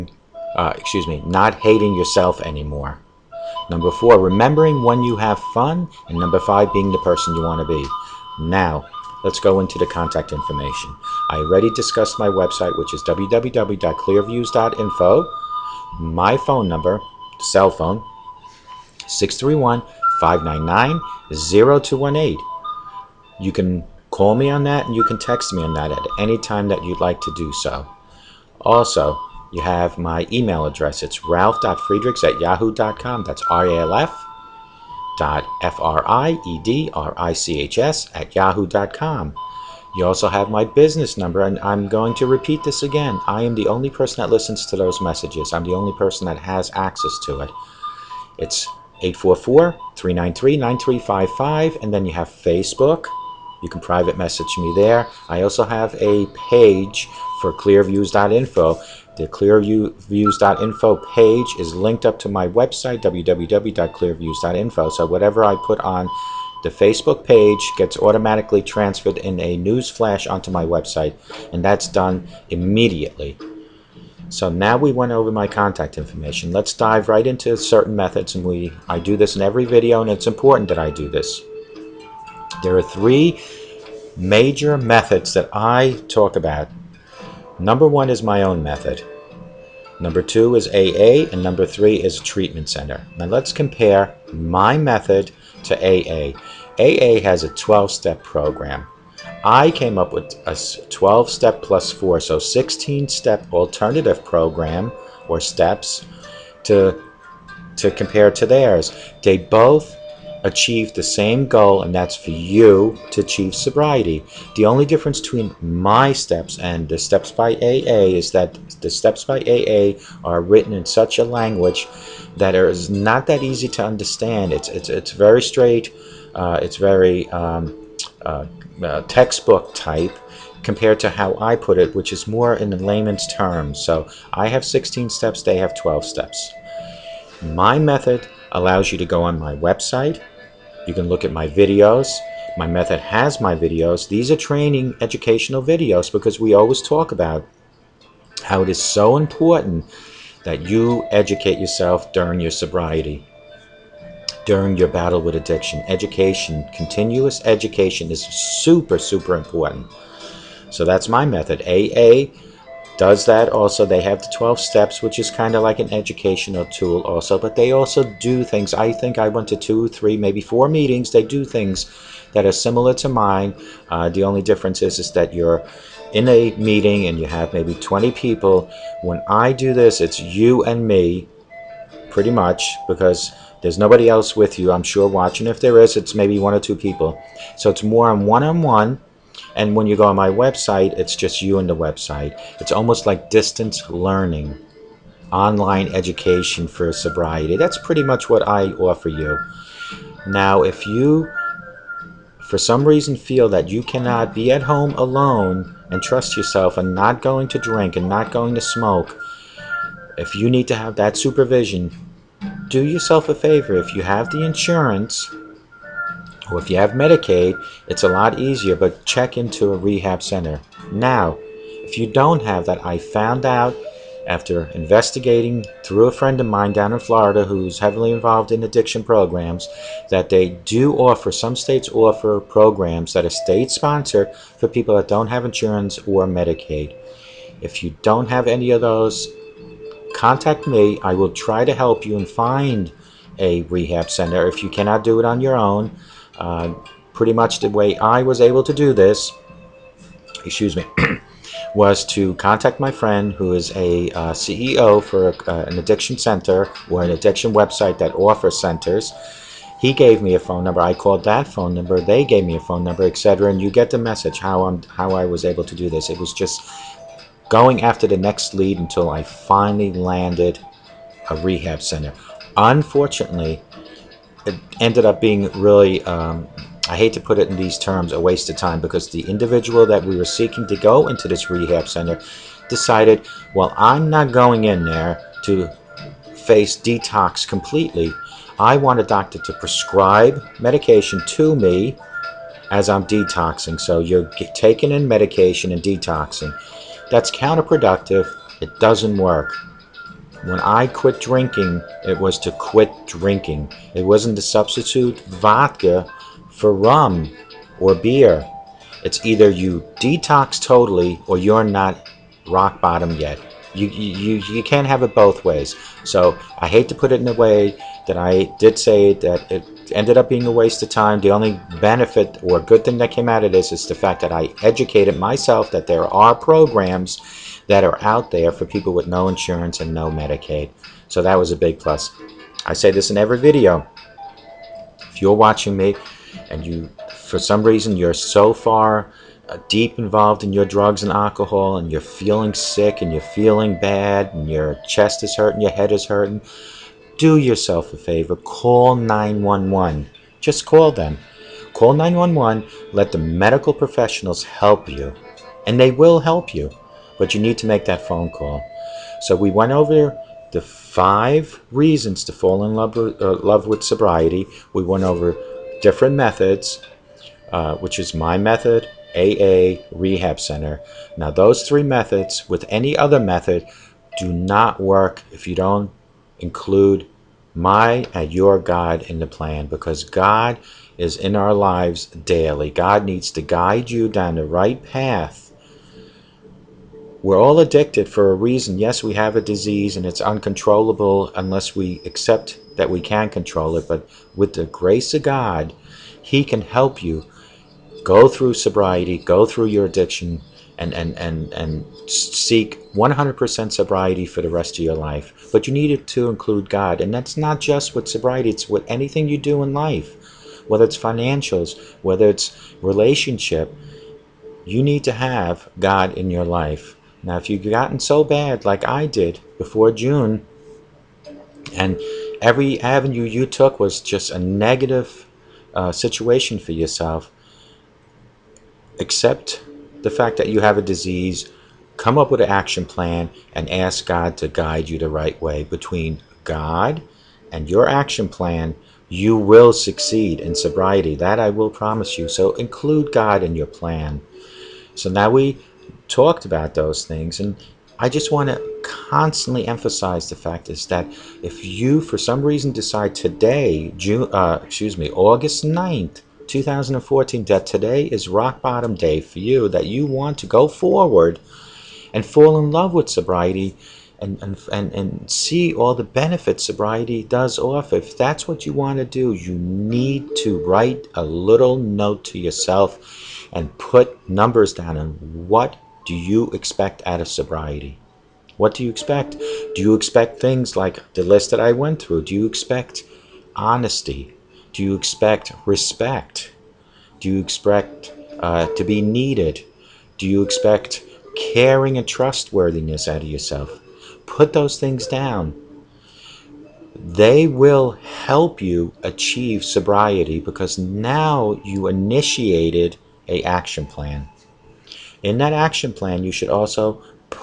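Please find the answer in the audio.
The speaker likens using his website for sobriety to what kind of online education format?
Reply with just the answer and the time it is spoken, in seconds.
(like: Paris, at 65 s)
Distance learning, at 193 s.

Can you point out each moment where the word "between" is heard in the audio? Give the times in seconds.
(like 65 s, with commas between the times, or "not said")
115 s, 435 s.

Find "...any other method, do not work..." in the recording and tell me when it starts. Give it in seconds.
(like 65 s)
372 s.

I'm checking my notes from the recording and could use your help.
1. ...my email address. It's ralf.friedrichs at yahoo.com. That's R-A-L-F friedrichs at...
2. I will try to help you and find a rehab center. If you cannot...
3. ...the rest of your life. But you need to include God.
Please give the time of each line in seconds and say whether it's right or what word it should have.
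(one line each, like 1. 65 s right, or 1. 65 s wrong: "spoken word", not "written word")
1. 29 s right
2. 241 s right
3. 404 s right.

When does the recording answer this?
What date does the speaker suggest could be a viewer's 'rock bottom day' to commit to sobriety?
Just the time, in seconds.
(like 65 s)
455 s.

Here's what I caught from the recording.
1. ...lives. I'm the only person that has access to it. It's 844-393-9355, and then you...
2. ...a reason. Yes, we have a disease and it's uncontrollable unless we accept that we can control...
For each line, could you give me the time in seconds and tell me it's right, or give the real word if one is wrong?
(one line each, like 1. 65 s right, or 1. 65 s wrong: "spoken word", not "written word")
1. 44 s wrong: "messages", not "lives"
2. 388 s right.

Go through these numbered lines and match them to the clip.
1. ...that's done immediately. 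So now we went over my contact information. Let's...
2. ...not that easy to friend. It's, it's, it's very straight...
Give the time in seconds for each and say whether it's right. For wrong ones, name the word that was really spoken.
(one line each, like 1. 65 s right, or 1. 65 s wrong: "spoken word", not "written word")
1. 71 s right
2. 122 s wrong: "understand", not "friend".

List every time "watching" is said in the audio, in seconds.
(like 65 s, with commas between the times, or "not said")
185 s, 335 s.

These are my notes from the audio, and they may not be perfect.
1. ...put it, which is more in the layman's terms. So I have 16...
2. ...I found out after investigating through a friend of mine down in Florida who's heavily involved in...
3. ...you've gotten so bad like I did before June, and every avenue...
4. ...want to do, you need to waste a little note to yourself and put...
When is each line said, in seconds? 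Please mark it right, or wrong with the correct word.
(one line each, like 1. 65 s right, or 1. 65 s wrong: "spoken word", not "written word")
1. 131 s right
2. 222 s right
3. 417 s right
4. 468 s wrong: "write", not "waste".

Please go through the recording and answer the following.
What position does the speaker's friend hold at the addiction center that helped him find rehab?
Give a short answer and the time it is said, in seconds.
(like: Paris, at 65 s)
CEO, at 254 s.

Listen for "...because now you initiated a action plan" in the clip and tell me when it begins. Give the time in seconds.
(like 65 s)
500 s.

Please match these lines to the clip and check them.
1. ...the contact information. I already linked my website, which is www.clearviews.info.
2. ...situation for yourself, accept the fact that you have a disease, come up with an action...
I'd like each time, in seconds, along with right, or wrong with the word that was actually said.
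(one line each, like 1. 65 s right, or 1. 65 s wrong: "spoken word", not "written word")
1. 9 s wrong: "discussed", not "linked"
2. 425 s right.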